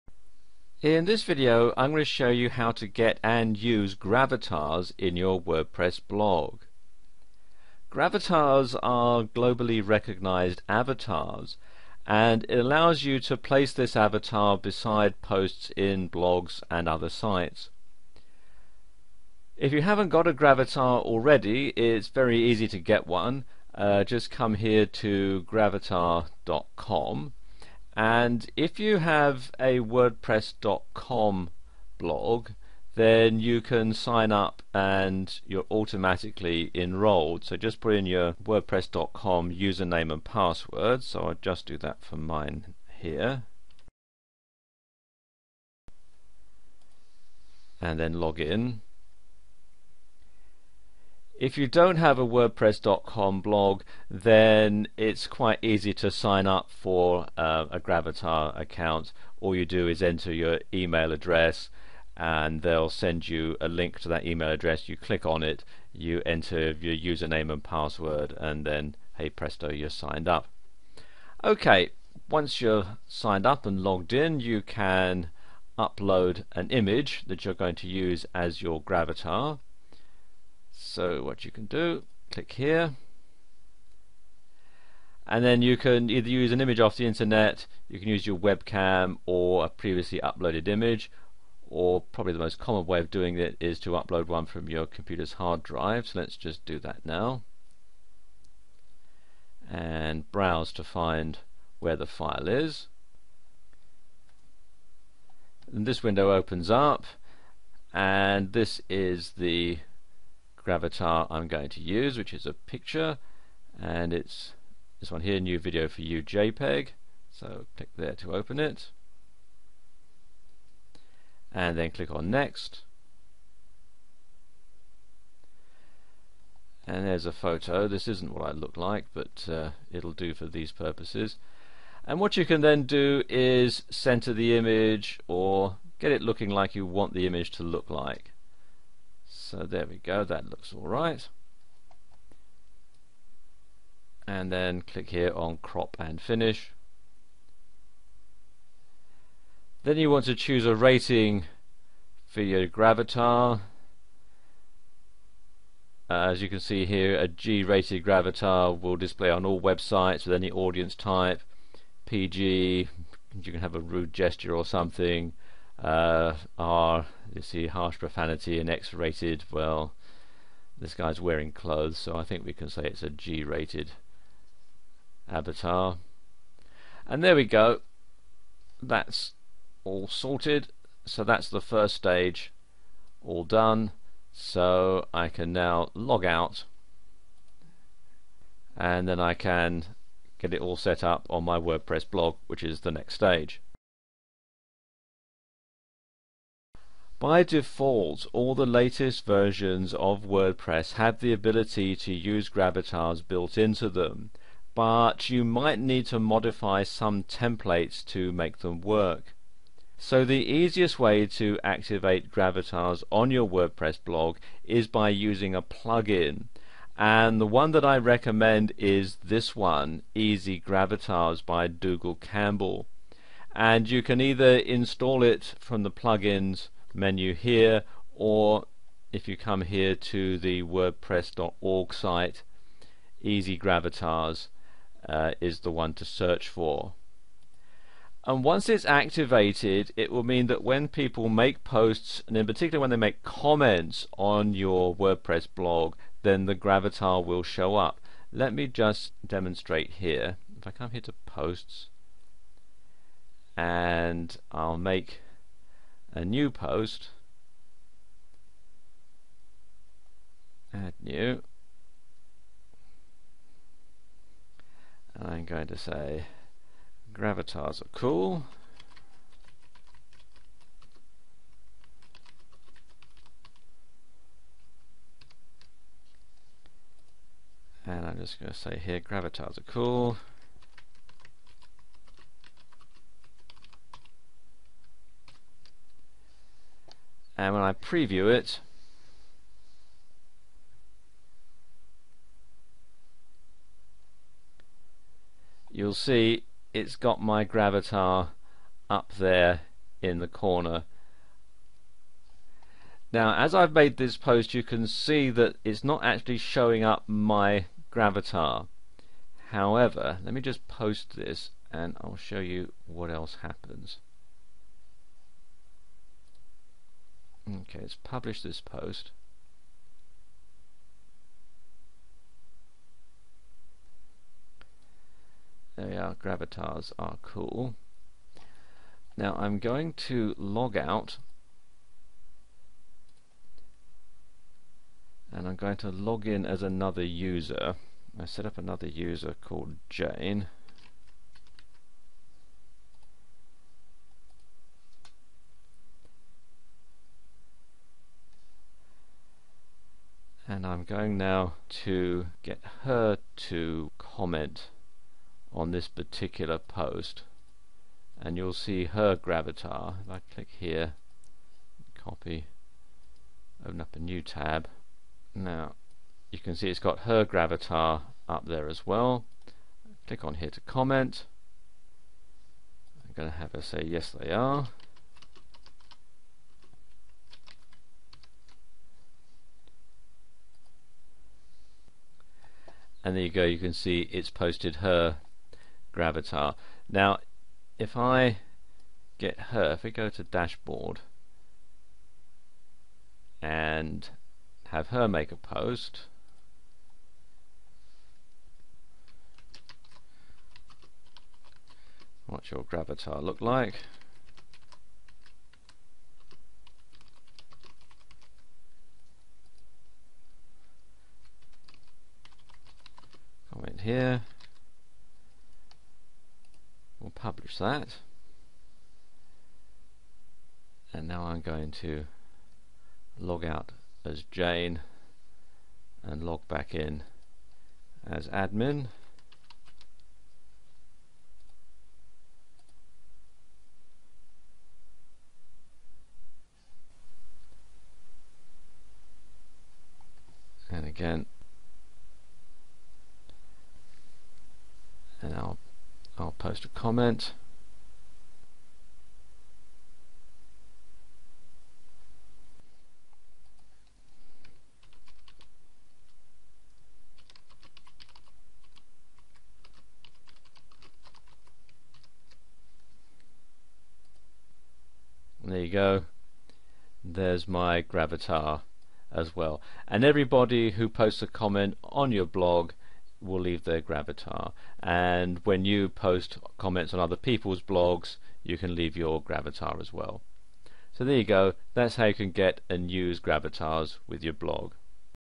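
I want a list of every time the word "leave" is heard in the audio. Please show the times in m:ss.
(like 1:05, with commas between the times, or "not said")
7:53, 7:58.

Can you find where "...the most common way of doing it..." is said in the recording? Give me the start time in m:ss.
1:32.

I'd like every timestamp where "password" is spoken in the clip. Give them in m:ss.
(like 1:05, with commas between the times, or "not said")
0:40, 1:07.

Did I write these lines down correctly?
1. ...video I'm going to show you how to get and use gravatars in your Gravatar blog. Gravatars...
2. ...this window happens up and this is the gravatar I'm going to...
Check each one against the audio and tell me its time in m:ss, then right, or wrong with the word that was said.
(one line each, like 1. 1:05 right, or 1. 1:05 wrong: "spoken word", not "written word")
1. 0:01 wrong: "WordPress", not "Gravatar"
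2. 1:45 wrong: "opens", not "happens".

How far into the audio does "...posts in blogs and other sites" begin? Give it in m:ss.
0:15.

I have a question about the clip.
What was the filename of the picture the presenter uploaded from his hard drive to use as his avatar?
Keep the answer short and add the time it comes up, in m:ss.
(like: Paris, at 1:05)
new video for you JPEG, at 1:55.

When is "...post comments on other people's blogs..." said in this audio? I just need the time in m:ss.
7:55.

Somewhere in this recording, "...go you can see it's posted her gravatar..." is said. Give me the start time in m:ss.
6:23.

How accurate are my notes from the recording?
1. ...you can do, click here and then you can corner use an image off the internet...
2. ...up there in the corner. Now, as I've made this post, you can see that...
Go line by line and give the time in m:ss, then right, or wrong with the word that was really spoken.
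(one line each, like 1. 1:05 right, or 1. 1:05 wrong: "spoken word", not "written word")
1. 1:21 wrong: "either", not "corner"
2. 4:58 right.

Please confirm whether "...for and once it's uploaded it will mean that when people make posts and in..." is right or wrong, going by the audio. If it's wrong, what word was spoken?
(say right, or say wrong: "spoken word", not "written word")
wrong: "activated", not "uploaded".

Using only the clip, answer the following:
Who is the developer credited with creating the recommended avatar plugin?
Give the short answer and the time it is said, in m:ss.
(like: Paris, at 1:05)
Dougal Campbell, at 3:41.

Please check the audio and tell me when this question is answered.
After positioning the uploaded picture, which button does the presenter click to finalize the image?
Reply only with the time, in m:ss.
2:25.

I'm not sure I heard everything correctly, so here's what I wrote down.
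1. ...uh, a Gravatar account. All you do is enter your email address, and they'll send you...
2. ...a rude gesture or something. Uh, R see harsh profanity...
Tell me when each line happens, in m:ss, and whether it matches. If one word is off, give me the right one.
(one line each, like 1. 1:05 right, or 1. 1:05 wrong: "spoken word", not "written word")
1. 0:57 right
2. 2:43 right.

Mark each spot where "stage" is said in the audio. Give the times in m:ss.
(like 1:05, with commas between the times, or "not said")
3:01, 3:13.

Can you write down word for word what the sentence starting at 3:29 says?
So the easiest way to activate Gravatars on your WordPress blog is by using a plugin.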